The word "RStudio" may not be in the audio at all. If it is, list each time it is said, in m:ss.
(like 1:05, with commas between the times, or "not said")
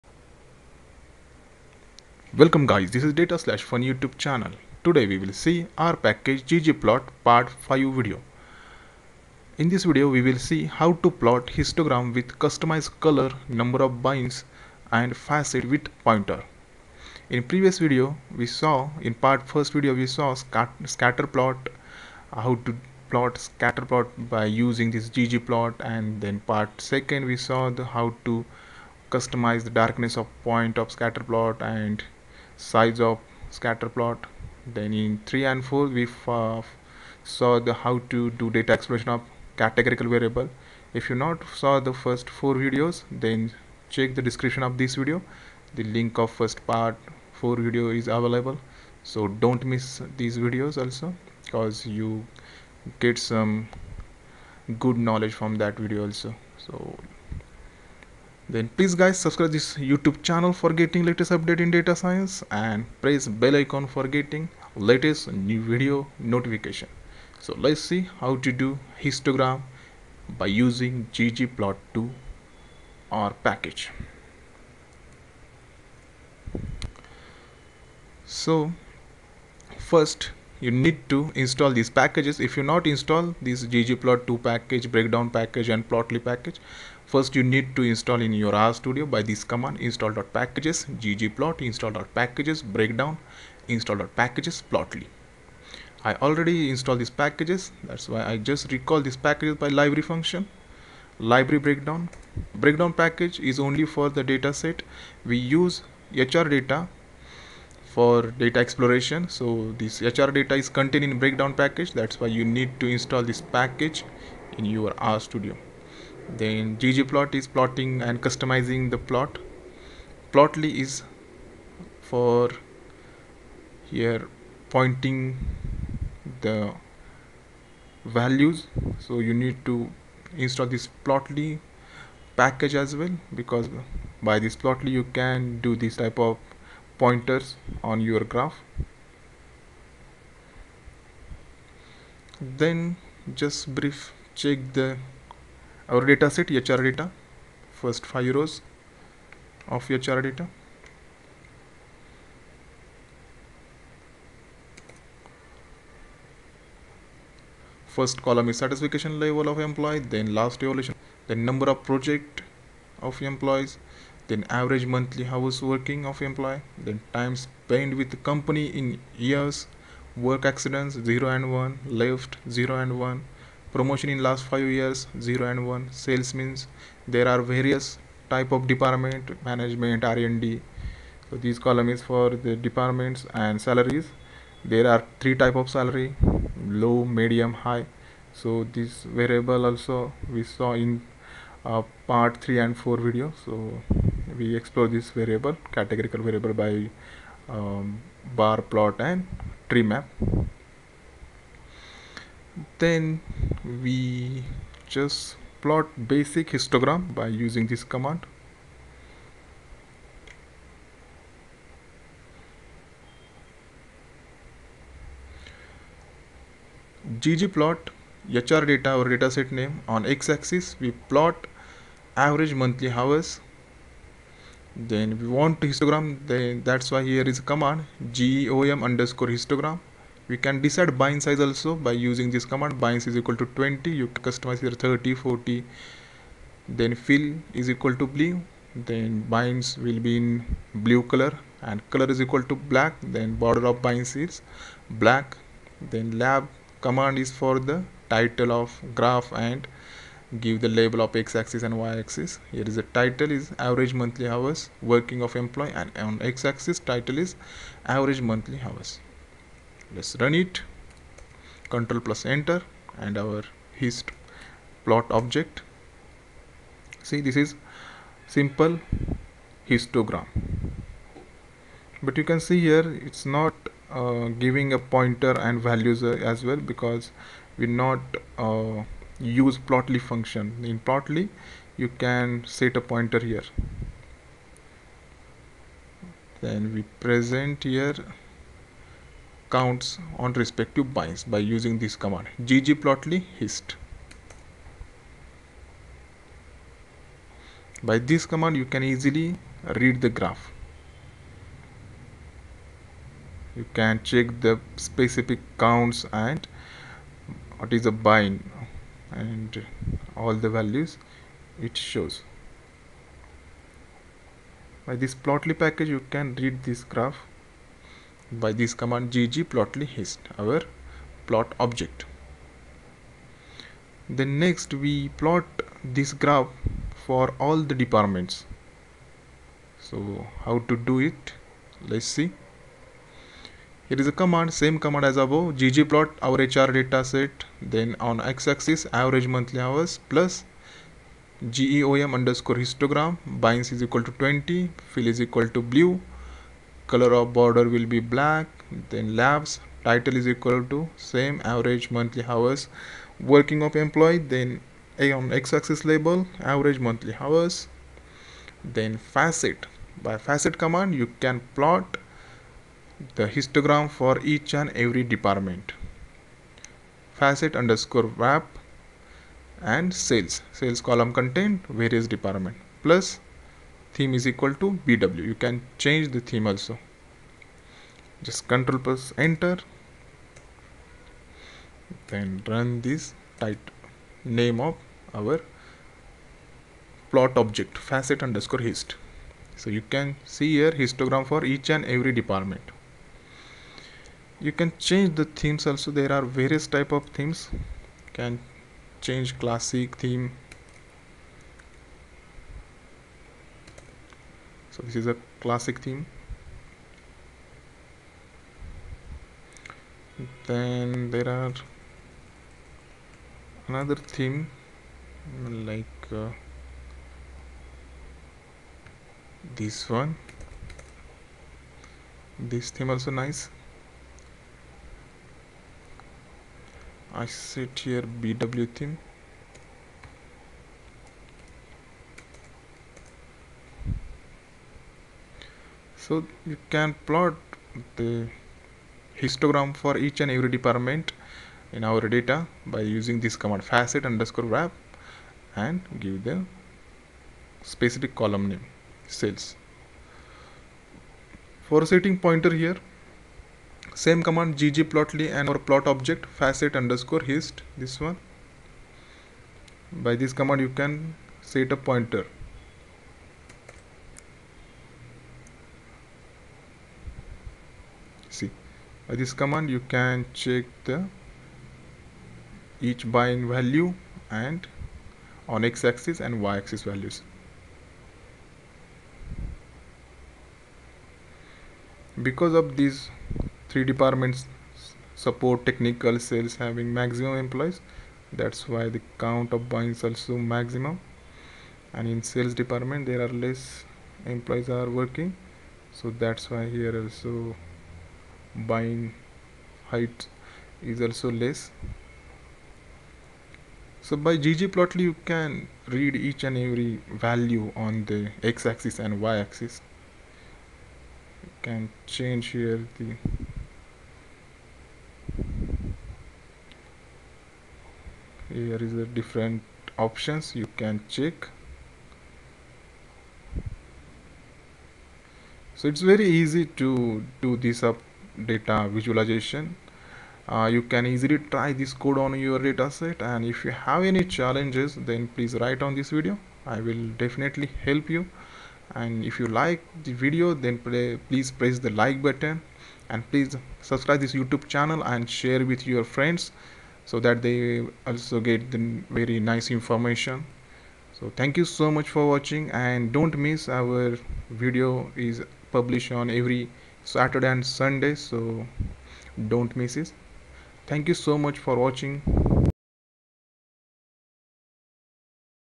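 1:28, 1:55.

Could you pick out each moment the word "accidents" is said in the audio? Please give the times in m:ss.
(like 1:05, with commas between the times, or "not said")
2:50.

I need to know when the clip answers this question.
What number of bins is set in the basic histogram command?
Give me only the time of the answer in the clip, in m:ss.
3:52.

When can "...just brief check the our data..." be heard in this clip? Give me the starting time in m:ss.
2:23.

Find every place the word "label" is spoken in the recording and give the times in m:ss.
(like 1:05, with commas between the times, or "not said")
4:10, 5:55.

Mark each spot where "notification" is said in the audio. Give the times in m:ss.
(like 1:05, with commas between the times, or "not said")
1:06.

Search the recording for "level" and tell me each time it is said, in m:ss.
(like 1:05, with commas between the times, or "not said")
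2:39.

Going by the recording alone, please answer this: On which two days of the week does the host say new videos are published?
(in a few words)
Saturday and Sunday.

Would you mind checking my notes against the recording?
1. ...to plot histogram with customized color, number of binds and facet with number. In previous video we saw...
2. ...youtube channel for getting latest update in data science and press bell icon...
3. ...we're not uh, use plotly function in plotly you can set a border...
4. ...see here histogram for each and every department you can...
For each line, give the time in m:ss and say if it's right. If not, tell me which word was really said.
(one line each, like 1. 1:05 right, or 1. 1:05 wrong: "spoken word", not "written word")
1. 0:11 wrong: "pointer", not "number"
2. 0:59 right
3. 4:37 wrong: "pointer", not "border"
4. 6:30 right.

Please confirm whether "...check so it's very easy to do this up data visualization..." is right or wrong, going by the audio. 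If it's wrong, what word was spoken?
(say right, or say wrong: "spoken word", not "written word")
right.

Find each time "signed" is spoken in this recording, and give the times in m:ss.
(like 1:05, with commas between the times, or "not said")
not said.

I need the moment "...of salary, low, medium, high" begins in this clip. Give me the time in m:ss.
3:05.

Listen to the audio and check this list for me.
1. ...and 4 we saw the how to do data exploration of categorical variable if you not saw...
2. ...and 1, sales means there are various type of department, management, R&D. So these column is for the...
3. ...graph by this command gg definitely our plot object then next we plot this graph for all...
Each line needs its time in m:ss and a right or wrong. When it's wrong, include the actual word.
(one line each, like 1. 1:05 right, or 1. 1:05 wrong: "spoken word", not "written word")
1. 0:35 right
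2. 2:55 right
3. 5:16 wrong: "plotly", not "definitely".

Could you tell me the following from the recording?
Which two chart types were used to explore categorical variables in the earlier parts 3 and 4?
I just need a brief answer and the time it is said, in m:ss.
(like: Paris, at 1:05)
bar plot and tree map, at 3:18.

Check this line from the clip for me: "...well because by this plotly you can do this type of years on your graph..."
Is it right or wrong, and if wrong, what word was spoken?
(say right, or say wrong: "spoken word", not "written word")
wrong: "pointers", not "years".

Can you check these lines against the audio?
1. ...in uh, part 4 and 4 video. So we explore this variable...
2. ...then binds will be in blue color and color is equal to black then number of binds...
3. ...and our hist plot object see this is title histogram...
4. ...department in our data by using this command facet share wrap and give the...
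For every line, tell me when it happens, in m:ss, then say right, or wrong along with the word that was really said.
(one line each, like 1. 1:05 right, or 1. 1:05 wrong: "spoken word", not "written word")
1. 3:10 wrong: "3", not "4"
2. 3:58 wrong: "border", not "number"
3. 4:22 wrong: "simple", not "title"
4. 7:20 wrong: "underscore", not "share".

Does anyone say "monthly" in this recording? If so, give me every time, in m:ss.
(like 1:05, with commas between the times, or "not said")
2:44, 3:42, 4:13, 4:18, 5:39, 5:51, 5:56.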